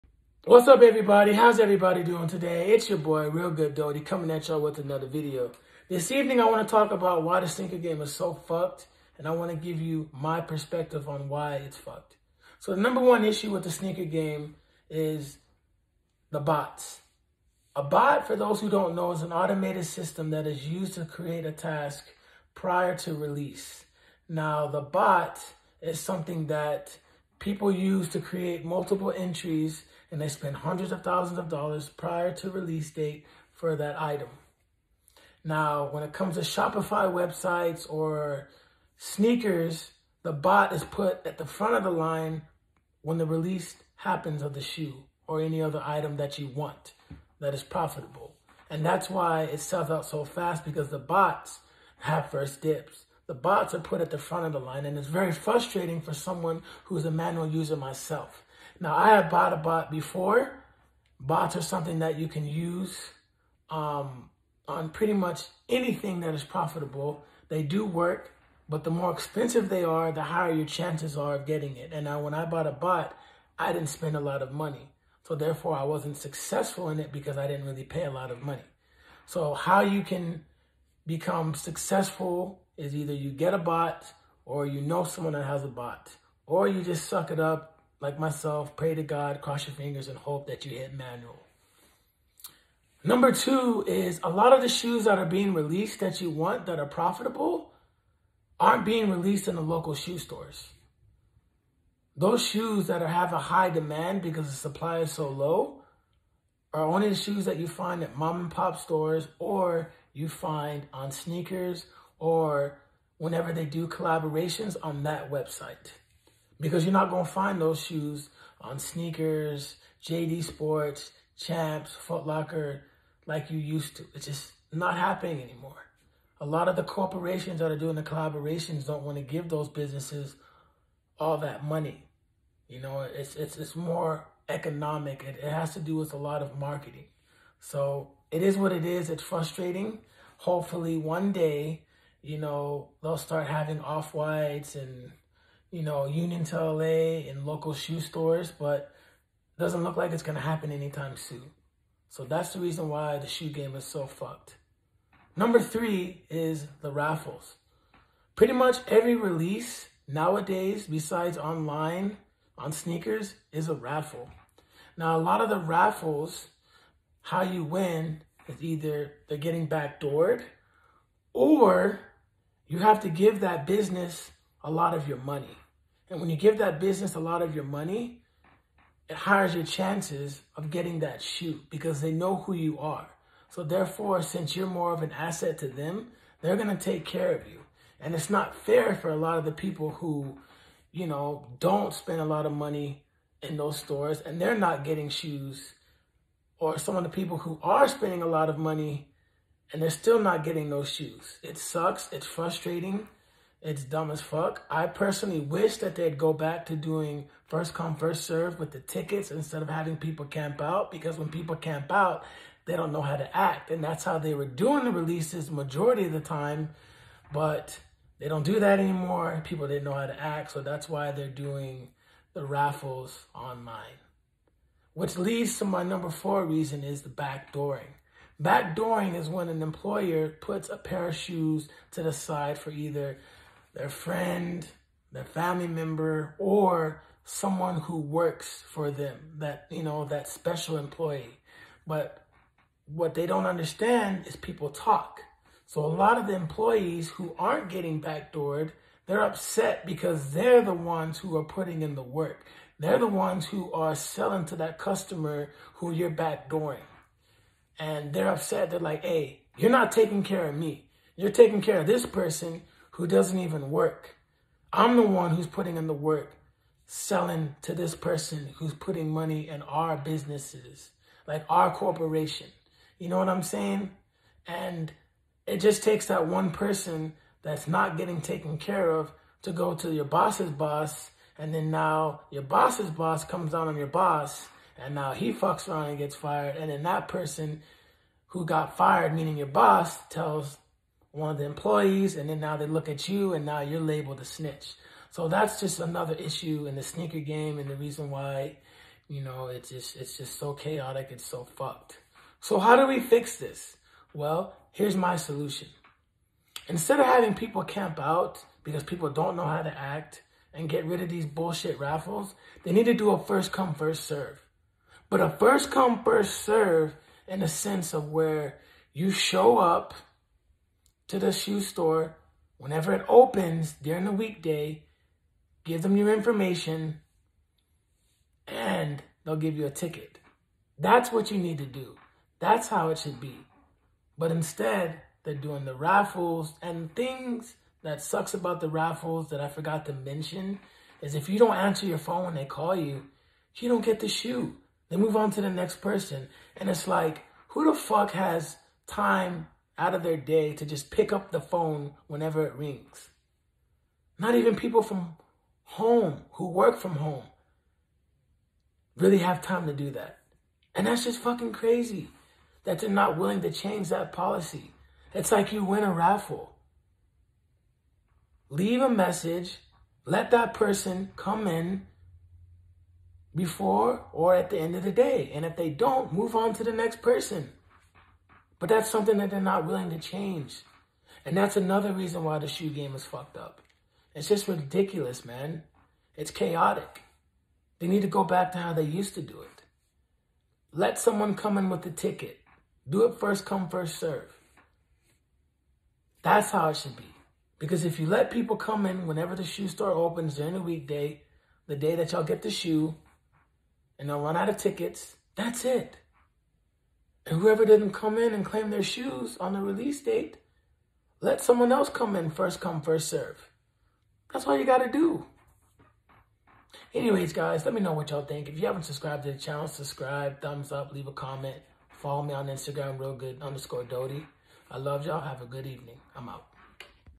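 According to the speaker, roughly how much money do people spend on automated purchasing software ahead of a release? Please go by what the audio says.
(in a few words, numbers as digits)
hundreds of thousands of dollars.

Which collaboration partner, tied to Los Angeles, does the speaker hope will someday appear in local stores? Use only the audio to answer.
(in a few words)
Union.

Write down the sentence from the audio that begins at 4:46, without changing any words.
And then that person who got fired, meaning your boss, tells one of the employees.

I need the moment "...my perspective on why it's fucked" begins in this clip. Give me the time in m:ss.
0:10.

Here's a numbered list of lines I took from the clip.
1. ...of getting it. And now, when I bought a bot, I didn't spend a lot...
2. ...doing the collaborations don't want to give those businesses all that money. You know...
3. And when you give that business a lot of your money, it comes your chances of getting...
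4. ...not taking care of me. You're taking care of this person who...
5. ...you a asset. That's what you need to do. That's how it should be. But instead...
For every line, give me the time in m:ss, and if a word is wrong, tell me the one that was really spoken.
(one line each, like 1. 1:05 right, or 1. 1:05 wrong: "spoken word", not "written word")
1. 1:11 right
2. 2:07 right
3. 2:56 wrong: "hires", not "comes"
4. 4:19 right
5. 5:29 wrong: "ticket", not "asset".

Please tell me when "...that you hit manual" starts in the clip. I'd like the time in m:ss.
1:30.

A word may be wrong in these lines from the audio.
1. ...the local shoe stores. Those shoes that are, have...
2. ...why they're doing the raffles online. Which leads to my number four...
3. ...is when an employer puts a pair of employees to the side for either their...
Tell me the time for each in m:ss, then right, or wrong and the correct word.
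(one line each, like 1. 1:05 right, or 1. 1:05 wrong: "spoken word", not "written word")
1. 1:39 right
2. 3:40 right
3. 3:49 wrong: "shoes", not "employees".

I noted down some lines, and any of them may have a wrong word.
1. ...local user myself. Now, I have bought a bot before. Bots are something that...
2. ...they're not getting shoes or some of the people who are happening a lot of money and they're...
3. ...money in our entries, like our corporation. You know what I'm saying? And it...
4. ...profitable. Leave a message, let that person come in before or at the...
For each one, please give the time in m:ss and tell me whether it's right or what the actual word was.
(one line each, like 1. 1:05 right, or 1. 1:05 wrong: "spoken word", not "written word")
1. 0:57 wrong: "manual", not "local"
2. 3:14 wrong: "spending", not "happening"
3. 4:29 wrong: "businesses", not "entries"
4. 6:05 wrong: "raffle", not "profitable".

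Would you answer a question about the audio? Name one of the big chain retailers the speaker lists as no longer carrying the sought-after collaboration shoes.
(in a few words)
JD Sports.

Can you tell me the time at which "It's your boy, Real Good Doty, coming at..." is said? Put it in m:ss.
0:02.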